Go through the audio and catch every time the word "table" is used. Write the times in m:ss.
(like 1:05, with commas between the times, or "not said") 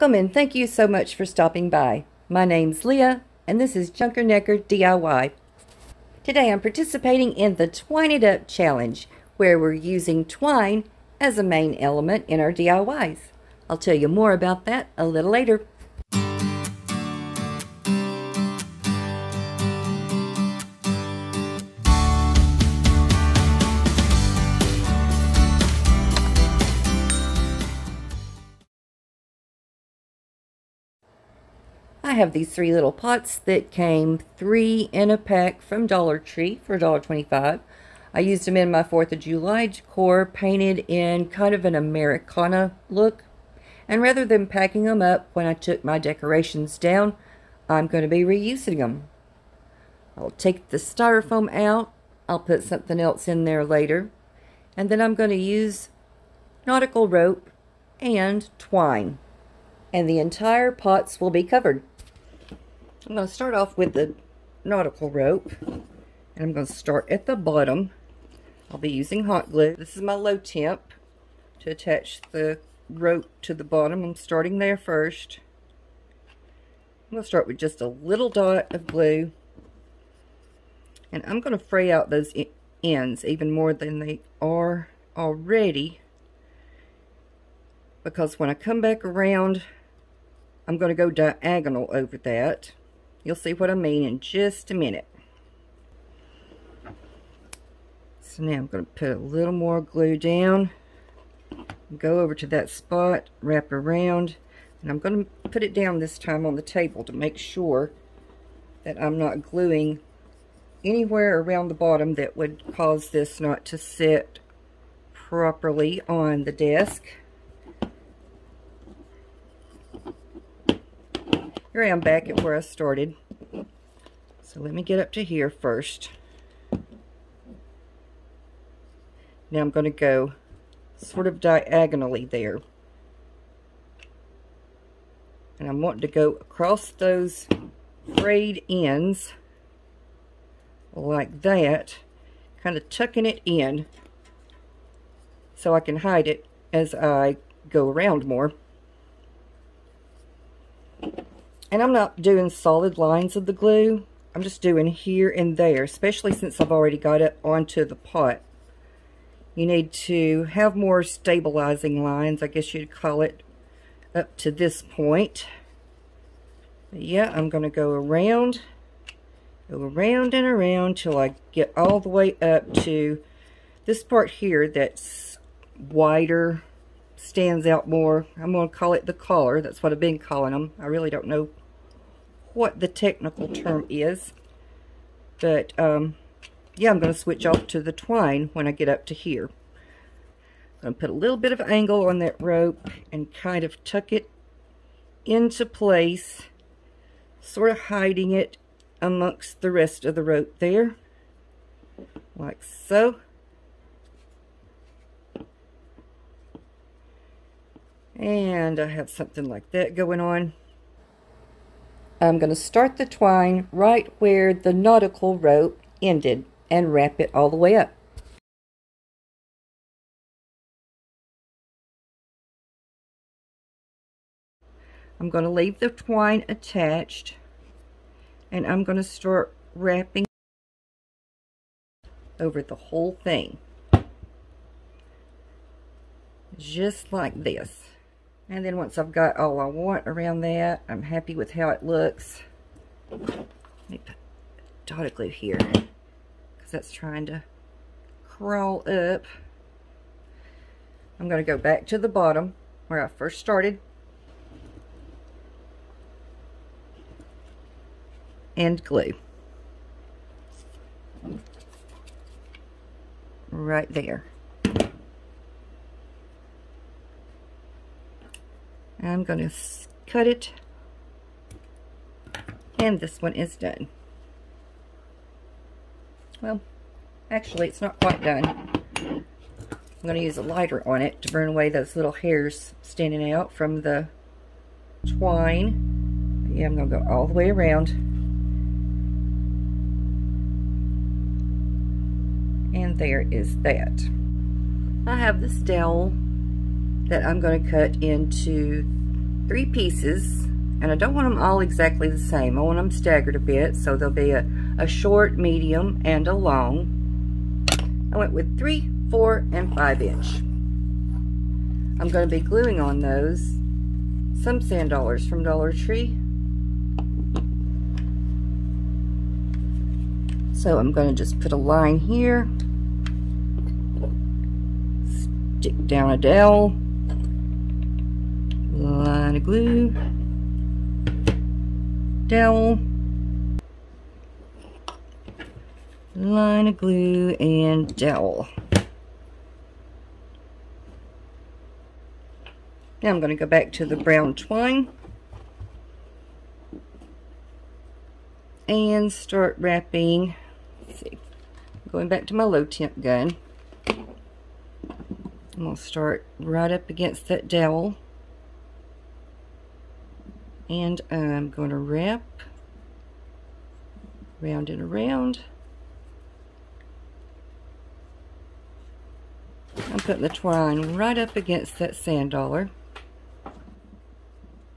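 1:46.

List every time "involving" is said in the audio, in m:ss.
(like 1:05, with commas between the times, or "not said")
not said.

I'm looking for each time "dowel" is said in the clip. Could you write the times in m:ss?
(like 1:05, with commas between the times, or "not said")
4:55, 5:26, 5:32, 5:37, 5:57.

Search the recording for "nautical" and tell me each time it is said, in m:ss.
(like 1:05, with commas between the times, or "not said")
0:56, 1:04, 3:34.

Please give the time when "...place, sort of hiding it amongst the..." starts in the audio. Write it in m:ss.
3:15.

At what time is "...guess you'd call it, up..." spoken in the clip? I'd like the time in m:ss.
2:42.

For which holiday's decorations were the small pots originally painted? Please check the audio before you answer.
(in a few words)
4th of July.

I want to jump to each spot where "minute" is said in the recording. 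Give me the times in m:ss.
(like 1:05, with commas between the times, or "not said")
1:34.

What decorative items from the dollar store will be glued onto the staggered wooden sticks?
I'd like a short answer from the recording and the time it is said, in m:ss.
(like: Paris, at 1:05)
sand dollars, at 5:14.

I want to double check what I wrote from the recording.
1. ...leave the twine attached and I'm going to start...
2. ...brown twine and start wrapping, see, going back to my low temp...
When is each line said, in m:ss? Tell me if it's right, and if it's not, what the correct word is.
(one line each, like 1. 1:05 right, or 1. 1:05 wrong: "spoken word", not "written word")
1. 3:45 right
2. 5:43 right.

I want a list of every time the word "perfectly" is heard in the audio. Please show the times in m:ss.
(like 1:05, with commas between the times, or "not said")
not said.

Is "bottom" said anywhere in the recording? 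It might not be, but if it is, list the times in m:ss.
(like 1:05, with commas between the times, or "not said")
1:07, 1:13, 1:51, 4:12.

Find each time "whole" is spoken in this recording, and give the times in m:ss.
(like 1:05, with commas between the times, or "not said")
3:52.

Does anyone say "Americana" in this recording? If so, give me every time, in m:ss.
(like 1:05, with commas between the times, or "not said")
0:41.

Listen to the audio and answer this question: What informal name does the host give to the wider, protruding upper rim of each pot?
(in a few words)
the collar.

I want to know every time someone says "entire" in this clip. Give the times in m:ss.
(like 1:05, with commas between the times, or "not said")
1:00.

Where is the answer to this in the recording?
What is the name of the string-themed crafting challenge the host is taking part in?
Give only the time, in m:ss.
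0:07.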